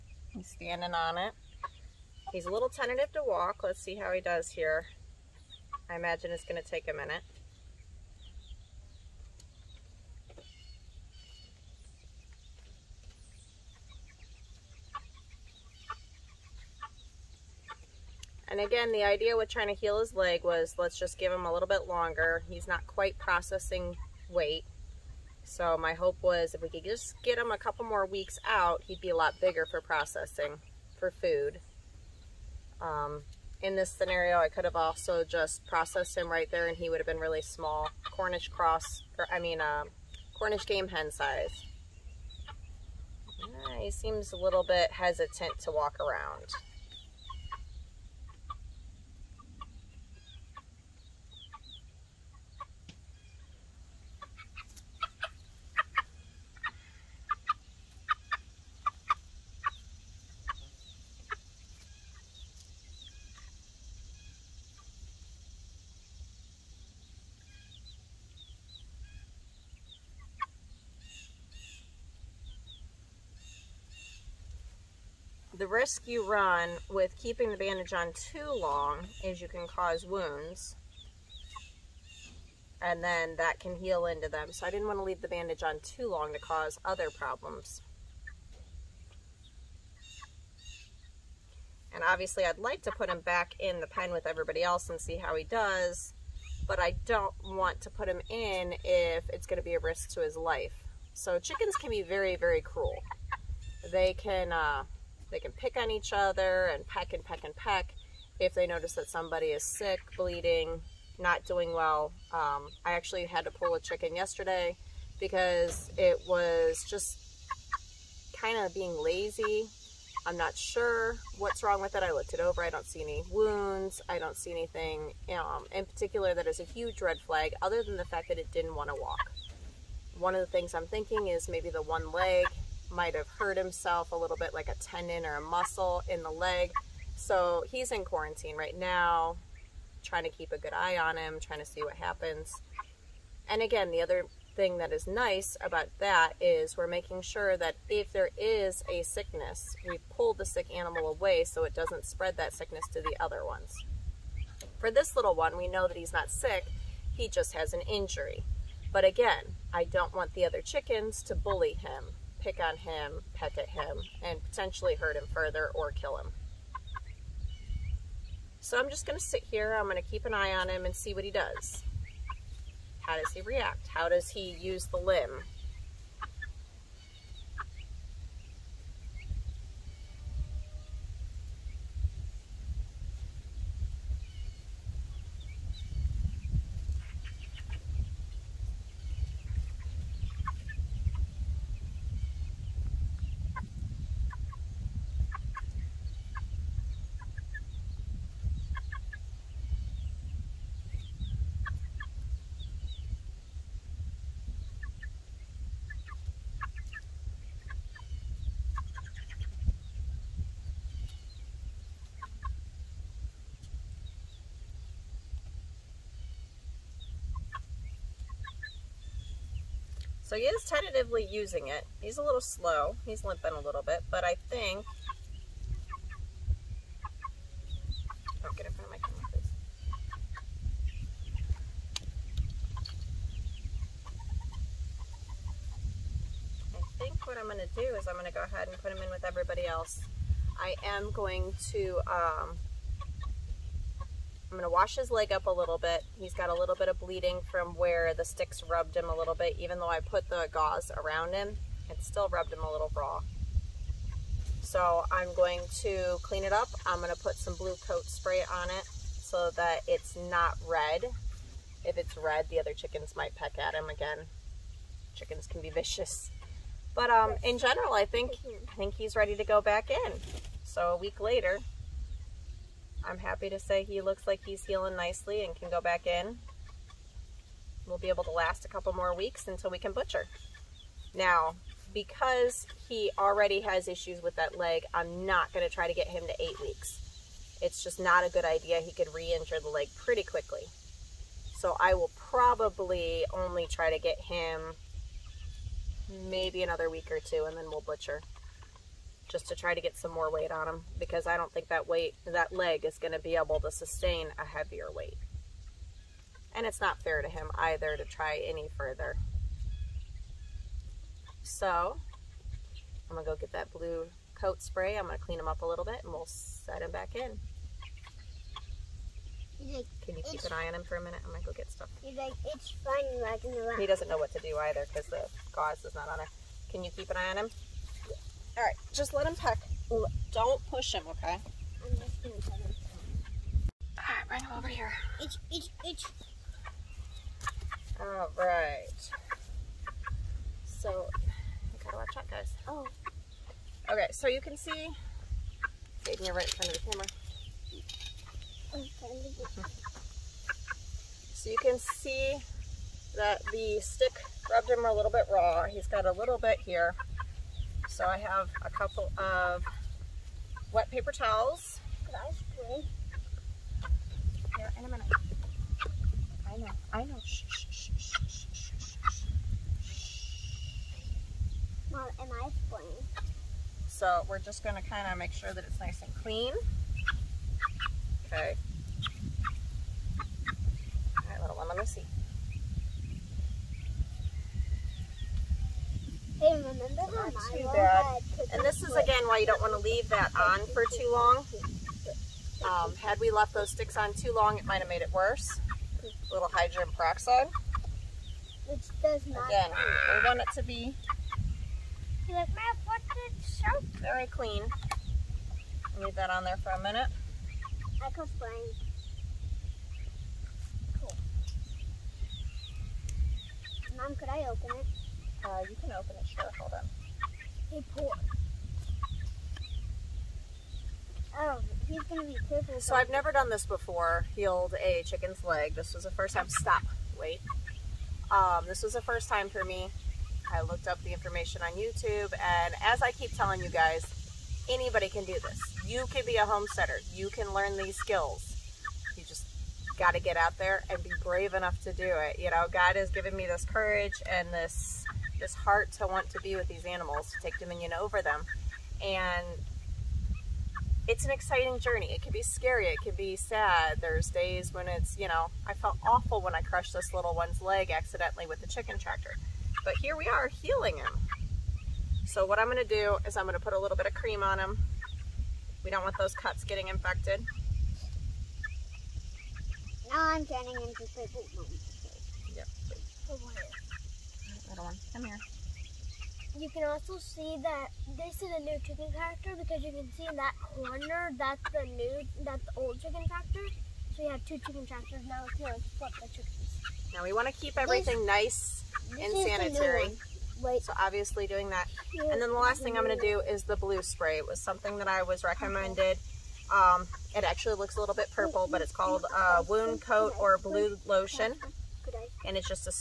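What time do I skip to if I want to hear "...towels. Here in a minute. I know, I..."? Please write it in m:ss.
6:01.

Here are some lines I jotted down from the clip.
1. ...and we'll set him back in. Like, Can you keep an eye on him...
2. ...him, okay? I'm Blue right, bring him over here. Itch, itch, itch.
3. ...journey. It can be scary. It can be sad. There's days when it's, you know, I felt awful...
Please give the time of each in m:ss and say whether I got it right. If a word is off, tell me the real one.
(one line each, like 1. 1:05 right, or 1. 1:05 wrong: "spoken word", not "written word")
1. 5:16 right
2. 5:30 wrong: "All", not "Blue"
3. 7:31 right.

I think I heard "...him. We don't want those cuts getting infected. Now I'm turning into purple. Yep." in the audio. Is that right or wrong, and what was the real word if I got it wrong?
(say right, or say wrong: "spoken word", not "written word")
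right.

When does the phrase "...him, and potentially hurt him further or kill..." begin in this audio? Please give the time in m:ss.
2:43.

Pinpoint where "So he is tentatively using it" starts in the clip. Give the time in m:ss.
3:40.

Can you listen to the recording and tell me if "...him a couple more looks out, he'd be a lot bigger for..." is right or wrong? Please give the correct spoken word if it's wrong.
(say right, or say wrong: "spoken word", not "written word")
wrong: "weeks", not "looks".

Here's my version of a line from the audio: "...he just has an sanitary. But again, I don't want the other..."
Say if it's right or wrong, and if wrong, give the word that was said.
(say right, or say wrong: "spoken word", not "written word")
wrong: "injury", not "sanitary".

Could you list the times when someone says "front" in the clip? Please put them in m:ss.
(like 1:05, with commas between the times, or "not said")
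3:48, 5:46.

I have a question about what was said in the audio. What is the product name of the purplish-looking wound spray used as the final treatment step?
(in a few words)
Wound-Kote.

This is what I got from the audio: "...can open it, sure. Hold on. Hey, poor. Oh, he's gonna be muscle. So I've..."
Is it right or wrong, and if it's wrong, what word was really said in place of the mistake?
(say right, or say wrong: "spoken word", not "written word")
wrong: "purple", not "muscle".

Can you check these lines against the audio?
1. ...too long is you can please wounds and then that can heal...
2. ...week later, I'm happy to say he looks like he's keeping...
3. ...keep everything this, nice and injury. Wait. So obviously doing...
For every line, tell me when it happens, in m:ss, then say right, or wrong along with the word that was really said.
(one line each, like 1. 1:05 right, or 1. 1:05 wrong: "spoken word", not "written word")
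1. 1:18 wrong: "cause", not "please"
2. 4:30 wrong: "healing", not "keeping"
3. 8:07 wrong: "sanitary", not "injury".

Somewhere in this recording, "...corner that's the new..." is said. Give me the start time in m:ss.
8:00.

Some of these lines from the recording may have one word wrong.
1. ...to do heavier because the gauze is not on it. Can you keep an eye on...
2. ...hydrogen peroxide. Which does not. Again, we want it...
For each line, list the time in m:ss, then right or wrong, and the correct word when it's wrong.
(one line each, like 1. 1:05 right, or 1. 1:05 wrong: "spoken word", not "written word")
1. 5:24 wrong: "either", not "heavier"
2. 6:36 right.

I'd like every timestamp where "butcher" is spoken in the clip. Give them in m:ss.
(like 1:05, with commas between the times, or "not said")
4:39, 4:57.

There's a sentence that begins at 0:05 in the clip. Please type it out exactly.
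I imagine it's going to take a minute.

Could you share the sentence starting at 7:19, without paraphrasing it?
You just got to get out there and be brave enough to do it.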